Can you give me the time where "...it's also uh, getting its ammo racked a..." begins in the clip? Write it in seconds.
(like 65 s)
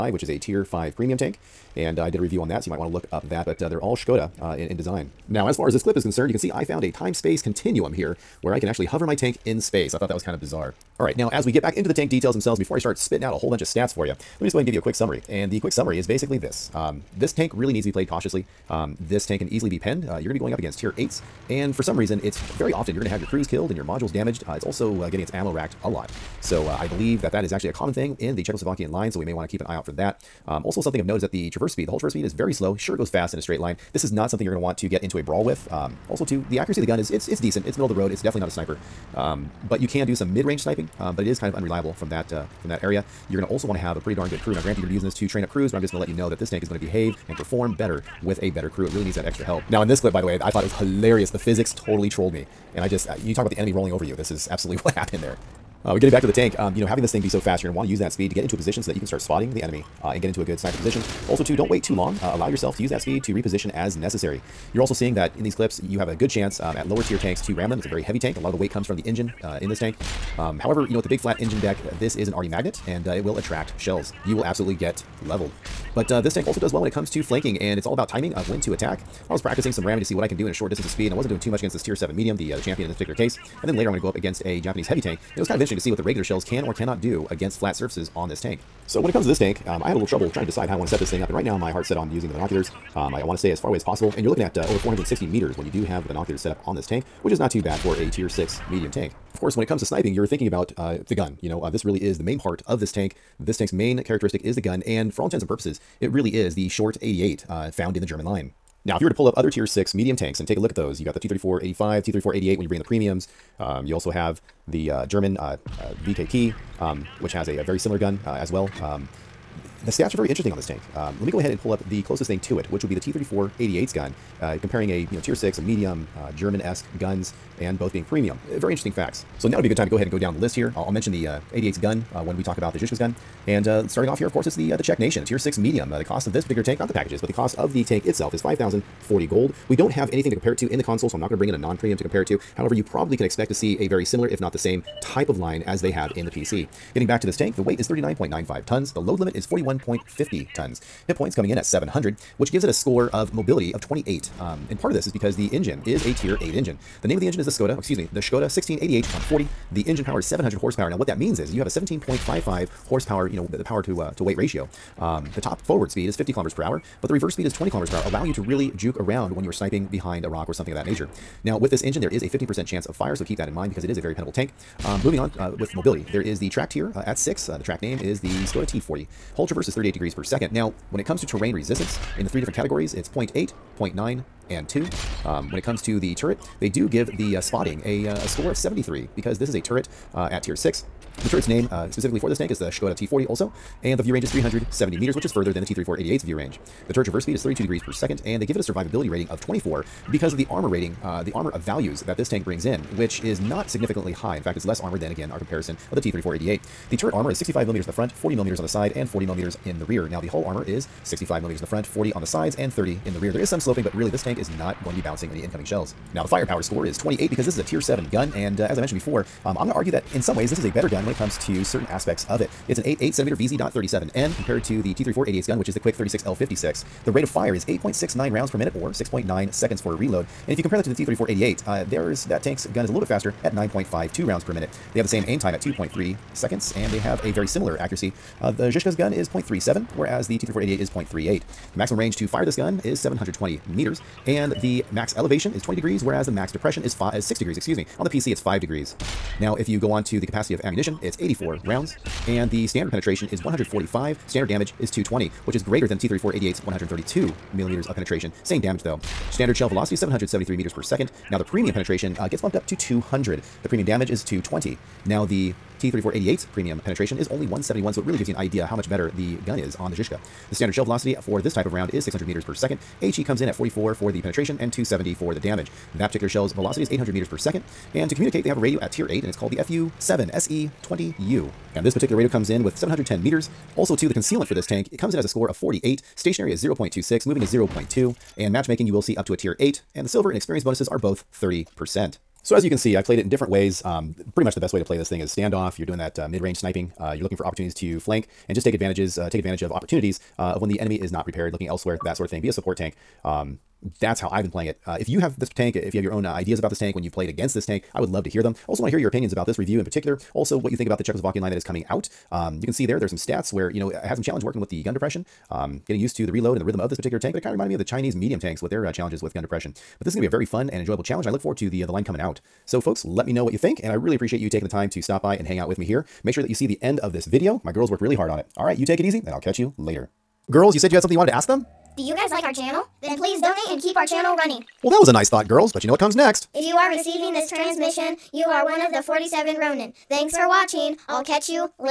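24 s.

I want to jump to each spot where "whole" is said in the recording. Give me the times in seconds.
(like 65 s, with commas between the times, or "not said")
13 s, 31 s.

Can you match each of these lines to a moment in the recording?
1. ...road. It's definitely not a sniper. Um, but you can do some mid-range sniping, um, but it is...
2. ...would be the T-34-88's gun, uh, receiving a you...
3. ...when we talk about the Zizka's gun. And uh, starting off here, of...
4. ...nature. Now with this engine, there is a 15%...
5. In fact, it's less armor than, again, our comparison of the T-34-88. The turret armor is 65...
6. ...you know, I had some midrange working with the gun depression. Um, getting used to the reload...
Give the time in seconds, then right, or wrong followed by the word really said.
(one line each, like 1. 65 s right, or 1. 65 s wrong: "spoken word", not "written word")
1. 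37 s right
2. 122 s wrong: "comparing", not "receiving"
3. 132 s right
4. 170 s right
5. 204 s right
6. 313 s wrong: "challenge", not "midrange".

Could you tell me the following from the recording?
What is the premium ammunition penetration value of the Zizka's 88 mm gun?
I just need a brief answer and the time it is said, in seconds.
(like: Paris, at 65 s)
200, at 262 s.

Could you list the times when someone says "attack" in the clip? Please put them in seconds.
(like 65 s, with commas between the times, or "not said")
78 s.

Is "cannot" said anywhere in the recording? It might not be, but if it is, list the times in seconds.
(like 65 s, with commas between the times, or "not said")
86 s.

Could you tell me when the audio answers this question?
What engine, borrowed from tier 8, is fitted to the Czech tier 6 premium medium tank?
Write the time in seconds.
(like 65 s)
158 s.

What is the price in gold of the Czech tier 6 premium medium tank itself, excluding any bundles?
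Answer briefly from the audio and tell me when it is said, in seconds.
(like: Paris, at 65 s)
5,040 gold, at 138 s.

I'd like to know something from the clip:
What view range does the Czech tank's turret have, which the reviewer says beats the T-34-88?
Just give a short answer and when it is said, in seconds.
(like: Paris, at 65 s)
370 meters, at 194 s.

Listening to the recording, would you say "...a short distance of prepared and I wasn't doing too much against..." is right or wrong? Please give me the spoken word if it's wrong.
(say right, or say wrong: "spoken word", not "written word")
wrong: "speed", not "prepared".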